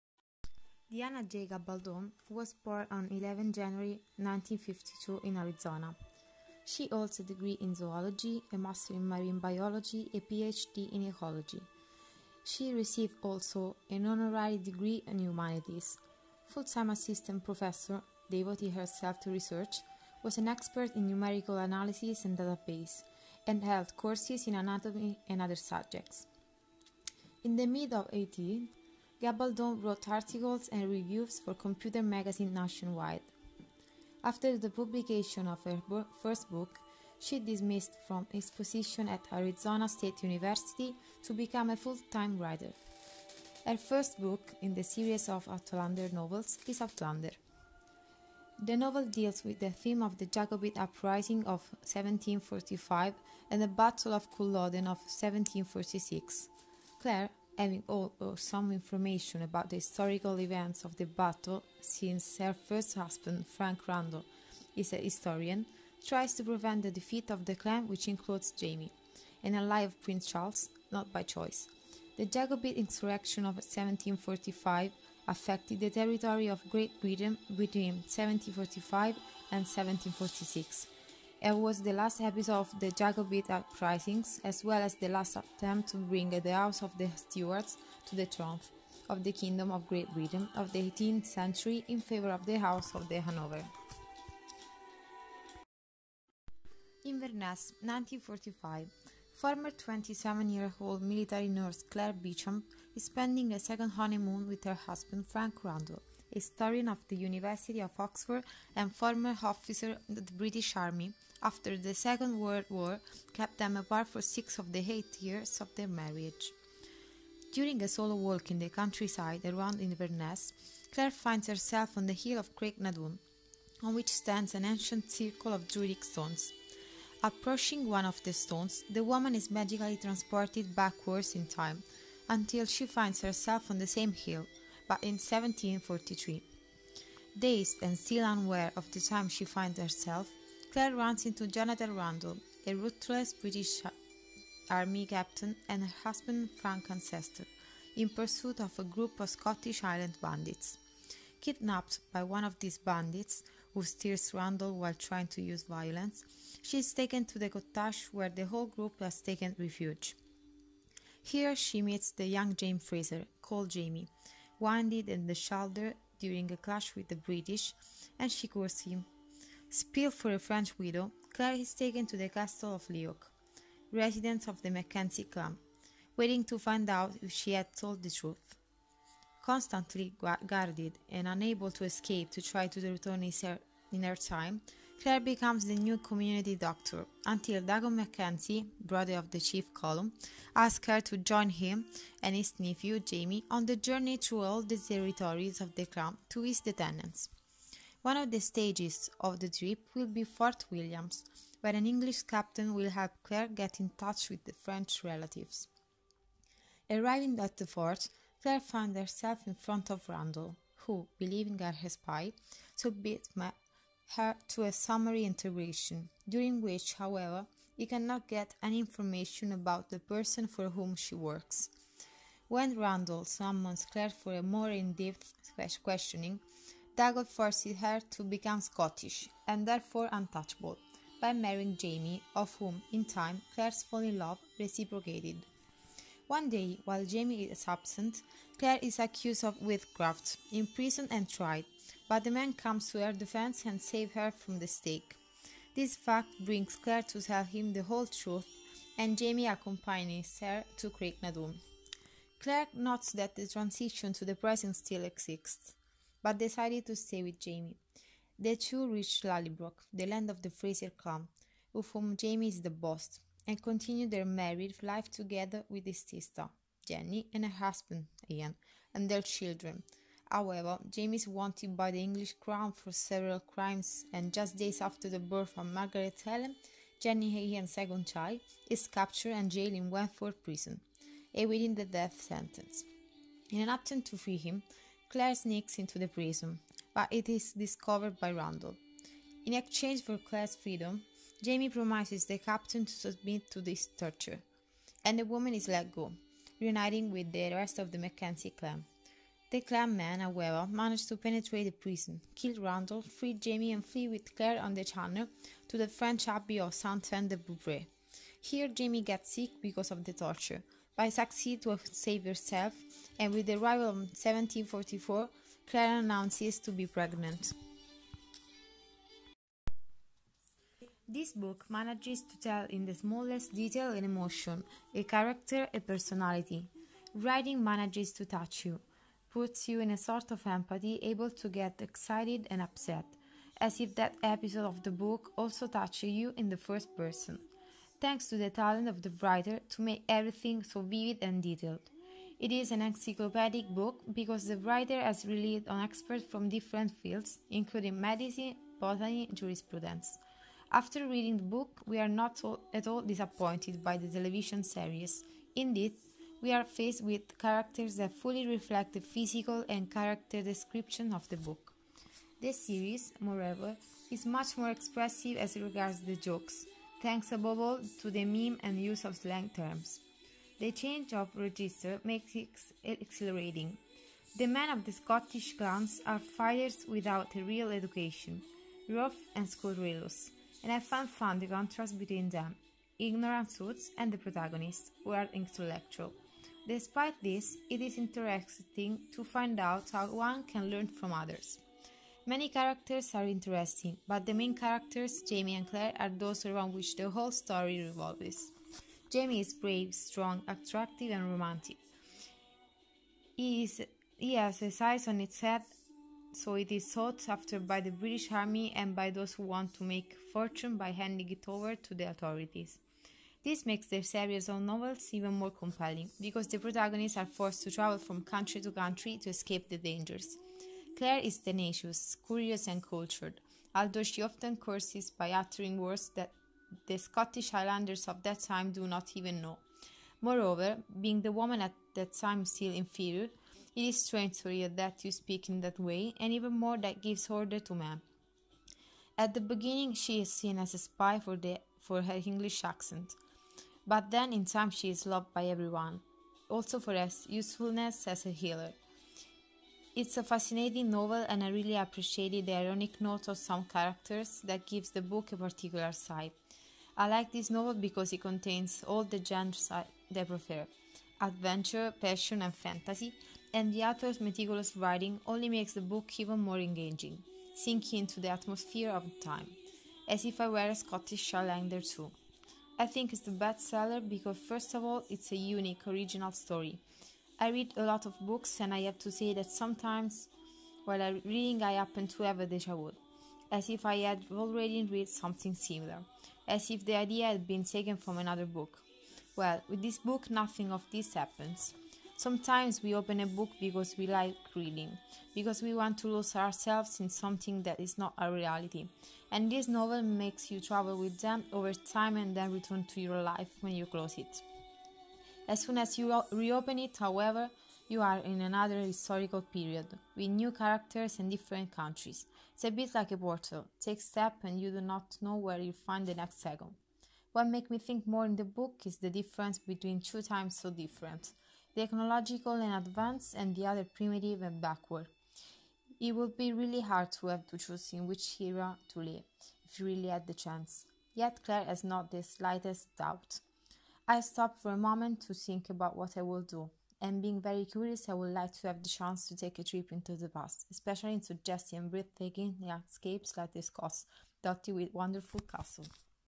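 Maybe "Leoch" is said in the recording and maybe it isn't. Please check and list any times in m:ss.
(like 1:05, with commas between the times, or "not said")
2:52.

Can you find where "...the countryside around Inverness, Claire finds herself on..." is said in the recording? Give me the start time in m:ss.
1:58.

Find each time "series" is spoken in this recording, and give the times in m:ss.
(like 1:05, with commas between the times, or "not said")
0:44, 5:54, 6:02, 6:54.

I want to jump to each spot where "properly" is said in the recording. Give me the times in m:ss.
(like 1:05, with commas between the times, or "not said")
not said.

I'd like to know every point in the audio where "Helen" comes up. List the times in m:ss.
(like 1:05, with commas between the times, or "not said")
4:36.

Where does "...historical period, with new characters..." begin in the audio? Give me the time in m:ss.
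8:28.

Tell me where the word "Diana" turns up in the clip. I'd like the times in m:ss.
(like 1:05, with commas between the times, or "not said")
0:00.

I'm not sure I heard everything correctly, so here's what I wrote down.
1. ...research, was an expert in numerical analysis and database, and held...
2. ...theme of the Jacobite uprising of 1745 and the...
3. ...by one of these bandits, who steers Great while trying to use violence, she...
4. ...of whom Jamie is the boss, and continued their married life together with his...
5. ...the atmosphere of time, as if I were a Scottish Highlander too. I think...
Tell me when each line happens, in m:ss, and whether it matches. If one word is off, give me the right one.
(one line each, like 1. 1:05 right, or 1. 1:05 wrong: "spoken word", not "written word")
1. 0:19 right
2. 0:49 right
3. 2:32 wrong: "Randall", not "Great"
4. 4:21 right
5. 7:48 right.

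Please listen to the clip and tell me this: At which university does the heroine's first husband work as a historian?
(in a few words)
University of Oxford.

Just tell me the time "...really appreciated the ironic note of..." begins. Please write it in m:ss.
7:31.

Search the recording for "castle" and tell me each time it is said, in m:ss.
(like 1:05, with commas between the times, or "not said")
2:52, 9:05.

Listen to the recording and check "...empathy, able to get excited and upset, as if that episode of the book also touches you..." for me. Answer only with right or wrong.
right.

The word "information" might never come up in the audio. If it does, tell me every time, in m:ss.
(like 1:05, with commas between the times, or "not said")
0:58, 3:38.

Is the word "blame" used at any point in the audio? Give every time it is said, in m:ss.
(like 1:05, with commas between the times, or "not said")
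not said.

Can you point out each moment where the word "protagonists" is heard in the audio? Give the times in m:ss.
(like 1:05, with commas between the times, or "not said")
6:24, 6:56.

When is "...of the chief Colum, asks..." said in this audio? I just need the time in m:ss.
3:09.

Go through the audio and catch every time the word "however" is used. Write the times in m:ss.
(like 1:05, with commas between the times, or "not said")
3:36, 4:30, 5:00, 8:26.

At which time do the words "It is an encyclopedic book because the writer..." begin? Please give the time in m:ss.
5:42.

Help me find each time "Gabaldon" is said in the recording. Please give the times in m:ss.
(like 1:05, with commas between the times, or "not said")
0:01, 0:29.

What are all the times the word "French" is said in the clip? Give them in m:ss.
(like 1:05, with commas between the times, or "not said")
2:50, 3:24, 5:05.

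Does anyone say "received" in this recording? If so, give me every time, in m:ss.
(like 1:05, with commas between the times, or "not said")
0:12.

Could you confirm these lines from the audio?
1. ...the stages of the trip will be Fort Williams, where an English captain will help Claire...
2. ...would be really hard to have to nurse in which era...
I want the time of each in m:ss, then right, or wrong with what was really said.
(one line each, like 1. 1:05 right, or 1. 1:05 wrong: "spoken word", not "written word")
1. 3:18 right
2. 8:46 wrong: "choose", not "nurse".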